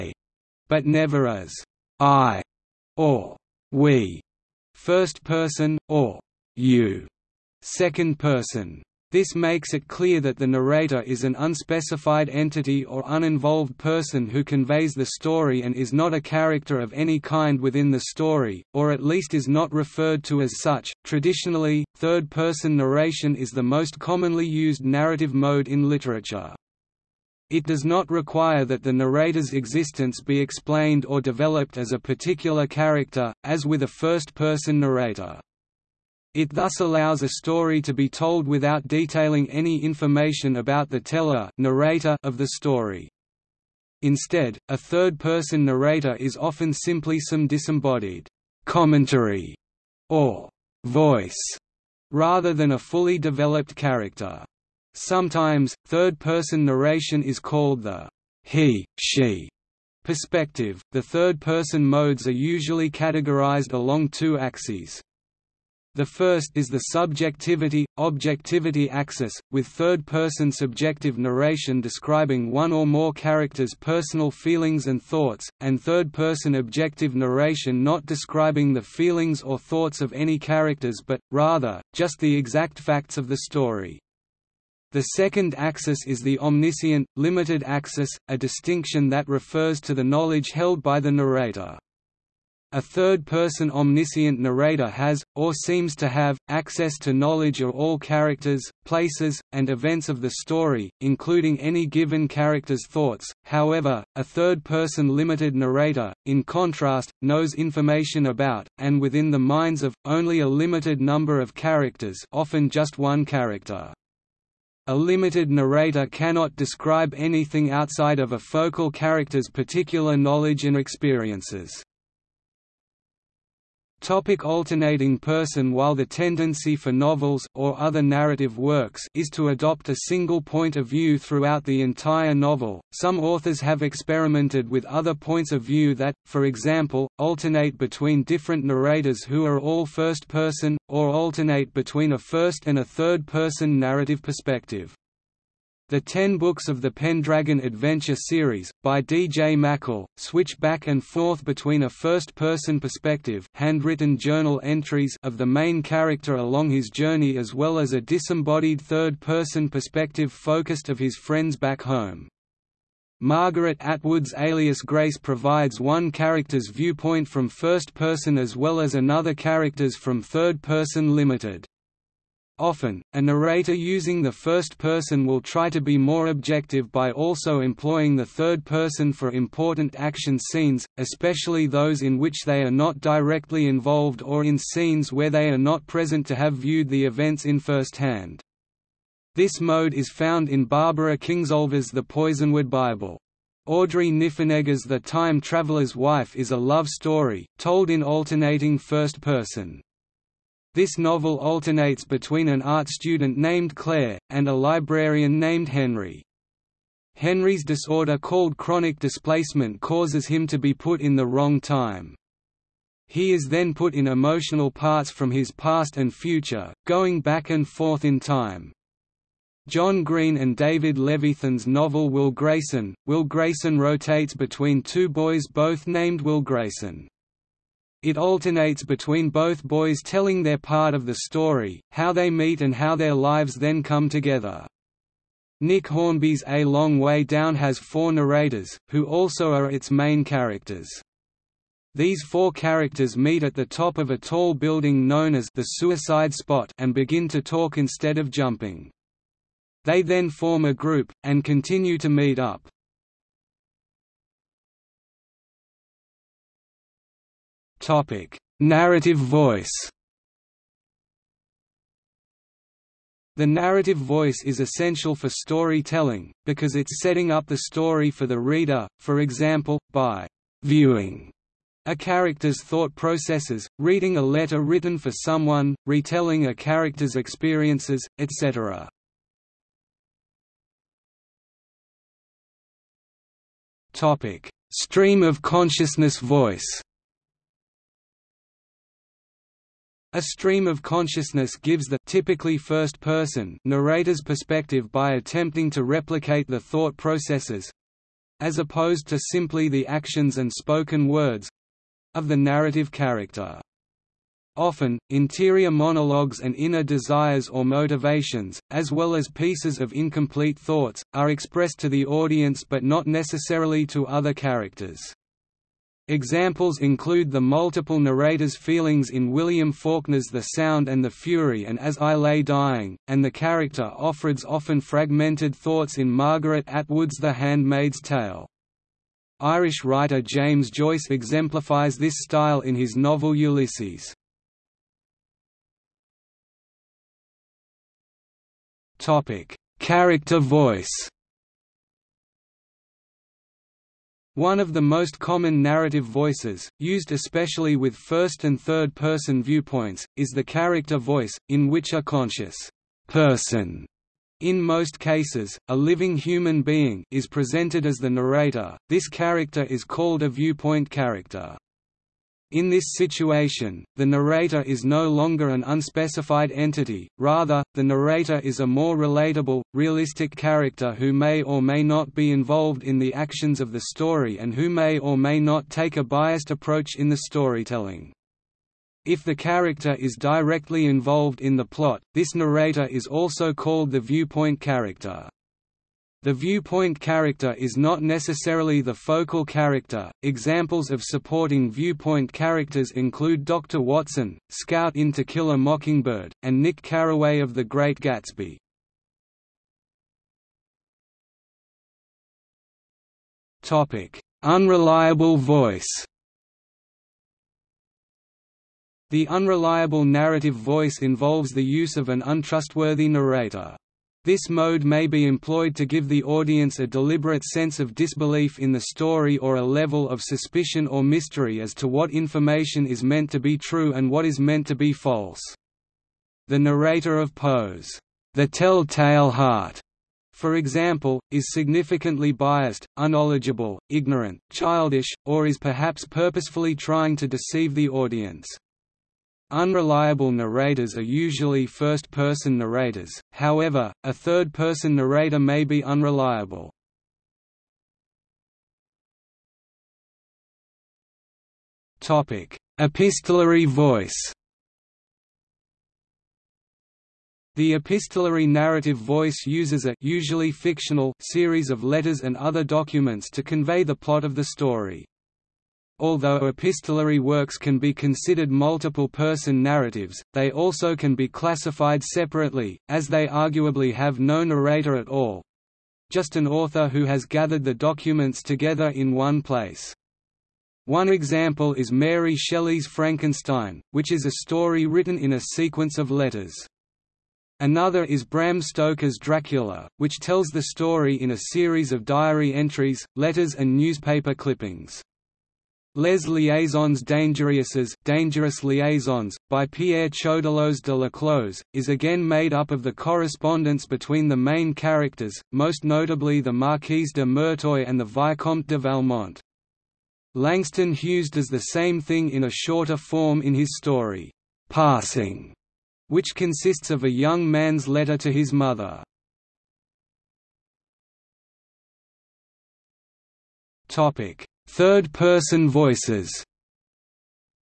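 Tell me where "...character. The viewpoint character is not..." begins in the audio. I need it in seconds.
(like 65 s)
384 s.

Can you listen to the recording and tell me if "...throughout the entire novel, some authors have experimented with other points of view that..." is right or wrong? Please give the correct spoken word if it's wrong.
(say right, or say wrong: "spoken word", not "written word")
right.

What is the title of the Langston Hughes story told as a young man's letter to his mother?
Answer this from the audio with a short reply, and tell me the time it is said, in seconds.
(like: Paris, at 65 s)
Passing, at 514 s.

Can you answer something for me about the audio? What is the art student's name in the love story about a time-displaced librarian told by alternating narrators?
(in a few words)
Claire.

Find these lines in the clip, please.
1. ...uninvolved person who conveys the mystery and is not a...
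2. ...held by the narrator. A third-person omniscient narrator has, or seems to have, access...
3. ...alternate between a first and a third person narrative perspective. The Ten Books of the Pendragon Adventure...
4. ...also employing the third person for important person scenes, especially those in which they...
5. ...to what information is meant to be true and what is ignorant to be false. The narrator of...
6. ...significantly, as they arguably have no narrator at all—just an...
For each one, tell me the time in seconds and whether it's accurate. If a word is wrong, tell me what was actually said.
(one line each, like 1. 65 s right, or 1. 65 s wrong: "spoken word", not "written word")
1. 13 s wrong: "story", not "mystery"
2. 90 s right
3. 141 s right
4. 177 s wrong: "action", not "person"
5. 421 s wrong: "meant", not "ignorant"
6. 472 s wrong: "separately", not "significantly".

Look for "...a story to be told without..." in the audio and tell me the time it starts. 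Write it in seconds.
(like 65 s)
37 s.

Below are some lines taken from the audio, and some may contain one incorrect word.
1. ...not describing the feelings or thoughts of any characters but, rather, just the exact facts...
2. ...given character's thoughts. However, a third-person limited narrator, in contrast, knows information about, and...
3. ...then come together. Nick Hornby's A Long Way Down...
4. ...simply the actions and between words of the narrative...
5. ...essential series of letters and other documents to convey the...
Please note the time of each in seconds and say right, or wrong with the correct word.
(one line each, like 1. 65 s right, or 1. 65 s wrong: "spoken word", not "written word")
1. 77 s right
2. 101 s right
3. 233 s right
4. 299 s wrong: "spoken", not "between"
5. 460 s wrong: "fictional", not "essential".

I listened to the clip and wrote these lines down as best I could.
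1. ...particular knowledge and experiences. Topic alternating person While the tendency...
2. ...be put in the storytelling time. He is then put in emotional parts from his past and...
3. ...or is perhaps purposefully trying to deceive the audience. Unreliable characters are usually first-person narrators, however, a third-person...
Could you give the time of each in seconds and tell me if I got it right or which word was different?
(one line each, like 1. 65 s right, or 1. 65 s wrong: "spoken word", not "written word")
1. 119 s right
2. 210 s wrong: "wrong", not "storytelling"
3. 435 s wrong: "narrators", not "characters".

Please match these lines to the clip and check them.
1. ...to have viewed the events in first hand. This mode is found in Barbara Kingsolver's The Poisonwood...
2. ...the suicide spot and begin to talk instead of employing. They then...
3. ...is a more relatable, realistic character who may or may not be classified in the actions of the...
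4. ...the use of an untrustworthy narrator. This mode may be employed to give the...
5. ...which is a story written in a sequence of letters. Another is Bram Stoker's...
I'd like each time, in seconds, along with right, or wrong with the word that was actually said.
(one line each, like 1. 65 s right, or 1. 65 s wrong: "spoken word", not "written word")
1. 186 s right
2. 245 s wrong: "jumping", not "employing"
3. 368 s wrong: "involved", not "classified"
4. 411 s right
5. 483 s right.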